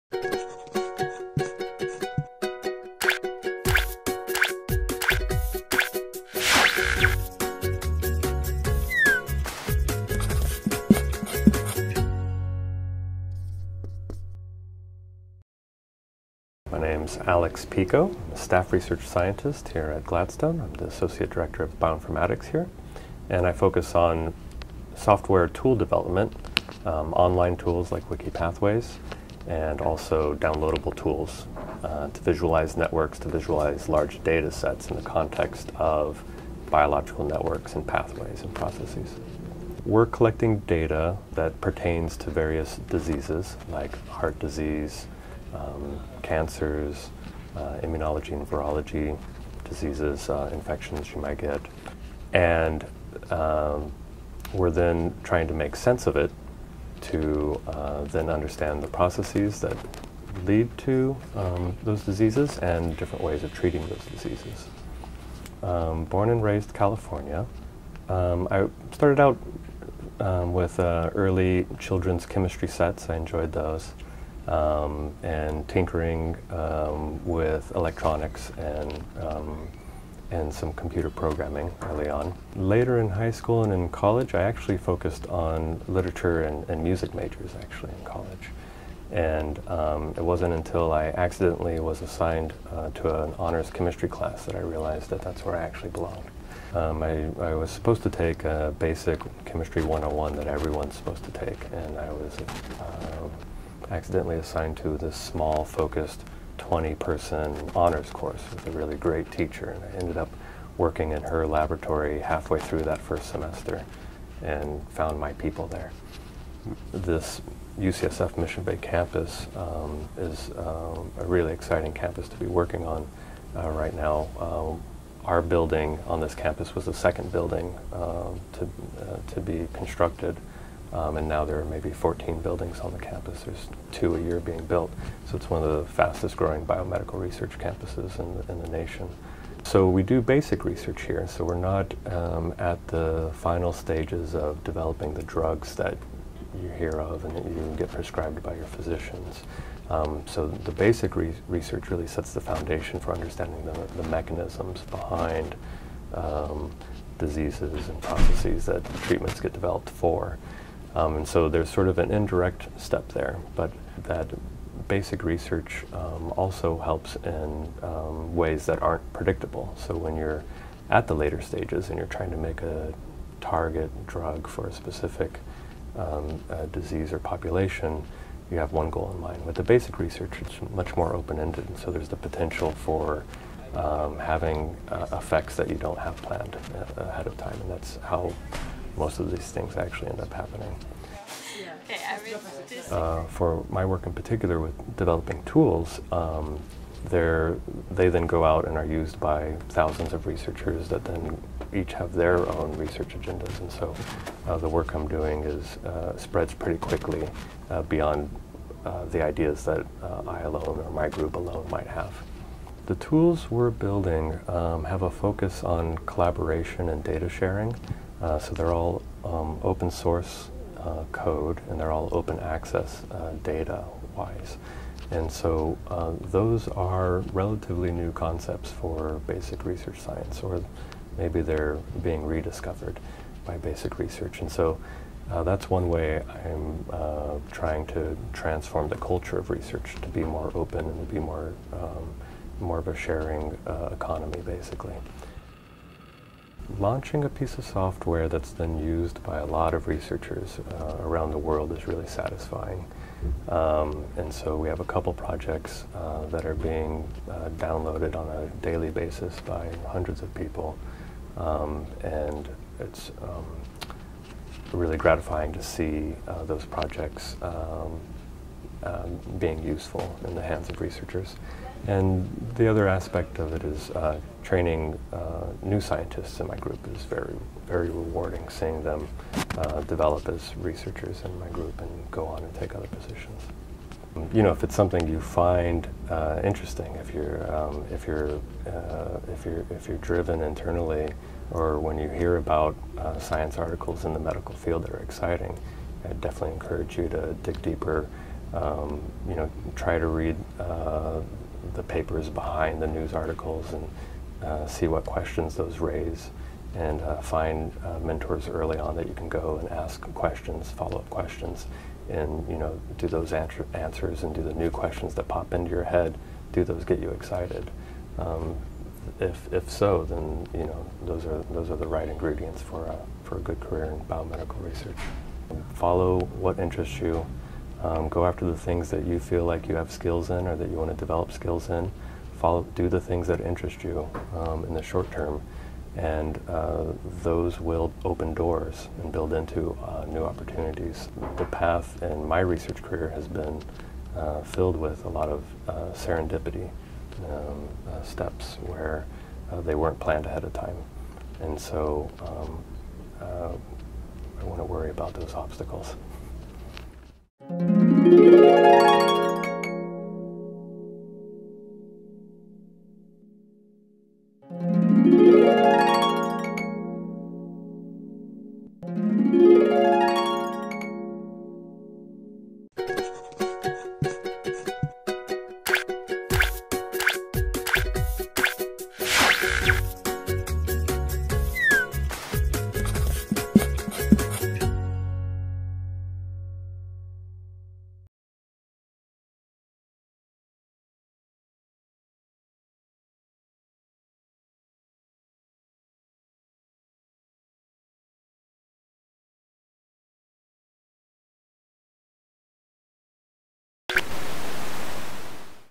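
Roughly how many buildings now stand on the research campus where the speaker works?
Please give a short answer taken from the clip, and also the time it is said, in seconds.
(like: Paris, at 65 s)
14, at 131 s.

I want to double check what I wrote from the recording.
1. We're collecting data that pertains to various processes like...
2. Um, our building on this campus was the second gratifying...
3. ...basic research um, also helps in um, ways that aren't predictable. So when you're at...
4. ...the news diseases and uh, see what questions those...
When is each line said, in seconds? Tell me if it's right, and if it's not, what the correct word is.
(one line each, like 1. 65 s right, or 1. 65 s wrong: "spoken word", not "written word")
1. 39 s wrong: "diseases", not "processes"
2. 124 s wrong: "building", not "gratifying"
3. 164 s right
4. 302 s wrong: "articles", not "diseases".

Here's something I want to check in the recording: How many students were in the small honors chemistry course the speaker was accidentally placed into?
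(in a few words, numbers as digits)
20.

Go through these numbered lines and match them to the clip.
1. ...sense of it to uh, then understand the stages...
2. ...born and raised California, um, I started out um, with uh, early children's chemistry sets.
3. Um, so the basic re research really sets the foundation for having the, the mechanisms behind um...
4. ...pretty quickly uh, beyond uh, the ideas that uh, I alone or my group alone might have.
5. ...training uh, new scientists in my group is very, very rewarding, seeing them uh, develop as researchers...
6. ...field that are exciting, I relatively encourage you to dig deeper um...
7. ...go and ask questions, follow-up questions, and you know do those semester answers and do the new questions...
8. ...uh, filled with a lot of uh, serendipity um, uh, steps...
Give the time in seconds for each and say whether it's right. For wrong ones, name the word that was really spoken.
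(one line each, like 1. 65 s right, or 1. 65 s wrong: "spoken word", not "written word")
1. 55 s wrong: "processes", not "stages"
2. 66 s right
3. 149 s wrong: "understanding", not "having"
4. 206 s right
5. 274 s right
6. 294 s wrong: "definitely", not "relatively"
7. 309 s wrong: "answer", not "semester"
8. 344 s right.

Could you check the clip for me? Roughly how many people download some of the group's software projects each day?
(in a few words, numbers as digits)
hundreds.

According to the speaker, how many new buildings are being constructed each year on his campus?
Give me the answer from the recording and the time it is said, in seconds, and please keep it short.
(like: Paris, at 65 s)
2, at 133 s.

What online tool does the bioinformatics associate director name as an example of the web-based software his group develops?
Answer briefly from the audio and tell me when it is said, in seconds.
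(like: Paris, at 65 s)
WikiPathways, at 28 s.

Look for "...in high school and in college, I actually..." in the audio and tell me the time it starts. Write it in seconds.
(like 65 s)
82 s.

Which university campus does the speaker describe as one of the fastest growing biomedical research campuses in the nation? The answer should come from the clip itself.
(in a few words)
UCSF Mission Bay.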